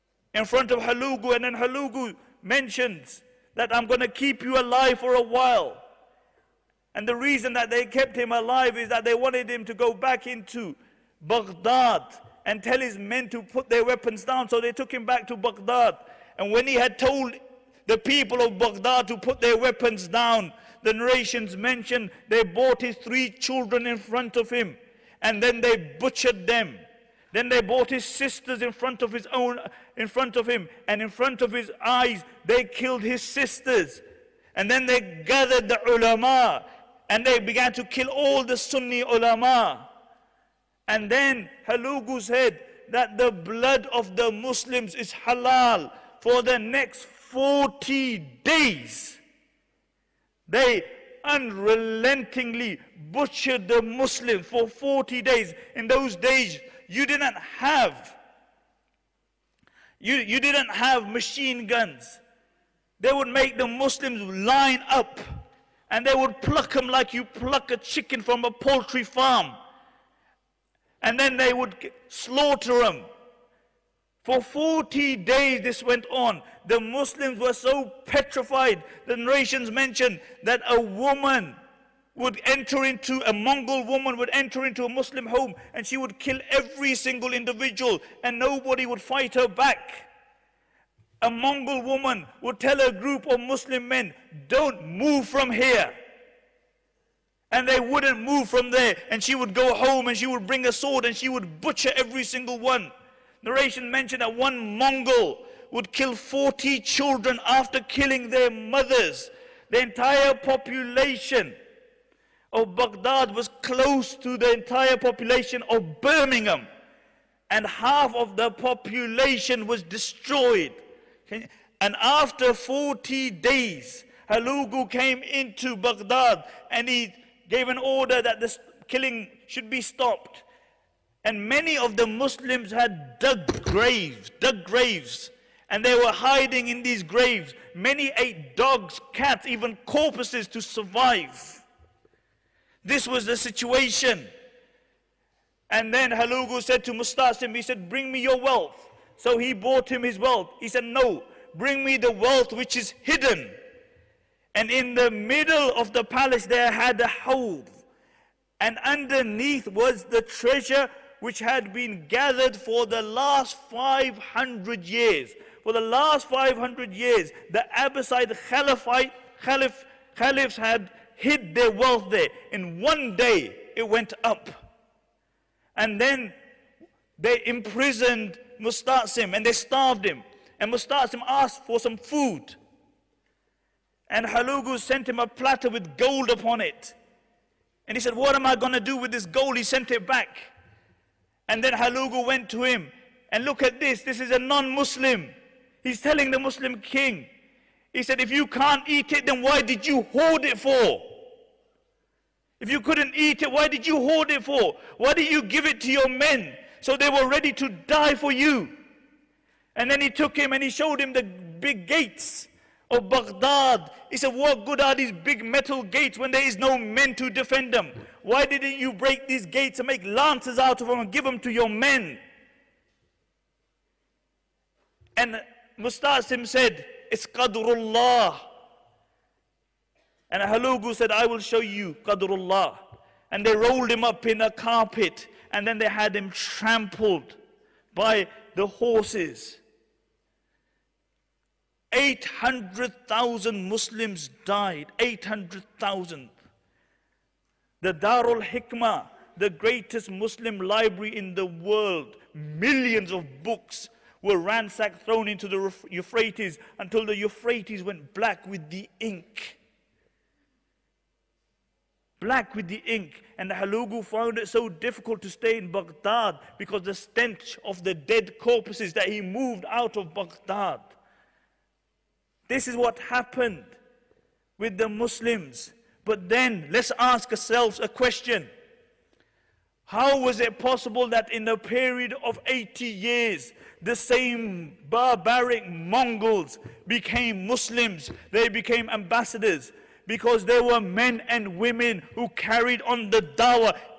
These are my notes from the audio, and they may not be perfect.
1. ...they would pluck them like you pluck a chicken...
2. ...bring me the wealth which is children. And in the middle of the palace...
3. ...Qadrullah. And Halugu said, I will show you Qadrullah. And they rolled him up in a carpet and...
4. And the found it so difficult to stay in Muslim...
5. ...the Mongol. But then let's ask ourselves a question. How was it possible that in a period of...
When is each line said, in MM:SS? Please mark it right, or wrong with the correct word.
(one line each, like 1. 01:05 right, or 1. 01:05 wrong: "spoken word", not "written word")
1. 01:06 right
2. 02:31 wrong: "hidden", not "children"
3. 03:47 right
4. 04:23 wrong: "Baghdad", not "Muslim"
5. 04:34 wrong: "Muslims", not "Mongol".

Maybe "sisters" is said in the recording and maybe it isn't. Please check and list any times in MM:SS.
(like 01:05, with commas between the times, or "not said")
00:28, 00:33.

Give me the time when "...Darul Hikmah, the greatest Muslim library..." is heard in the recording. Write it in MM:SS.
04:07.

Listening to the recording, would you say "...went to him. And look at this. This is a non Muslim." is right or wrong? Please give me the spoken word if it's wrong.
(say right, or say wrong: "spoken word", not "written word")
right.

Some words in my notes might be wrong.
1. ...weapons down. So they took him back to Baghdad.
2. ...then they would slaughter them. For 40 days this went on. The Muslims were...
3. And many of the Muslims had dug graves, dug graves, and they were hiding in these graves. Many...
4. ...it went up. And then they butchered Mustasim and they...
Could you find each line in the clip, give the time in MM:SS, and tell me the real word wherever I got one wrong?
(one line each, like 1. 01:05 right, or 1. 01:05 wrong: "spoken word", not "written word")
1. 00:13 right
2. 01:11 right
3. 02:11 right
4. 02:53 wrong: "imprisoned", not "butchered".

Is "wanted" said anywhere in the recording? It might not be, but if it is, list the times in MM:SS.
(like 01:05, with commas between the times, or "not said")
00:09.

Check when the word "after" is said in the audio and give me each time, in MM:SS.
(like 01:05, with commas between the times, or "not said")
01:47, 02:02.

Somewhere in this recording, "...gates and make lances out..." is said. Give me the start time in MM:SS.
03:39.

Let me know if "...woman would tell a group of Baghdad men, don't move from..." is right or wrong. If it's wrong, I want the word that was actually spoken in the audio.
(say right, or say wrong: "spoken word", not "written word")
wrong: "Muslim", not "Baghdad".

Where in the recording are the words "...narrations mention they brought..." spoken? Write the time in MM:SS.
00:20.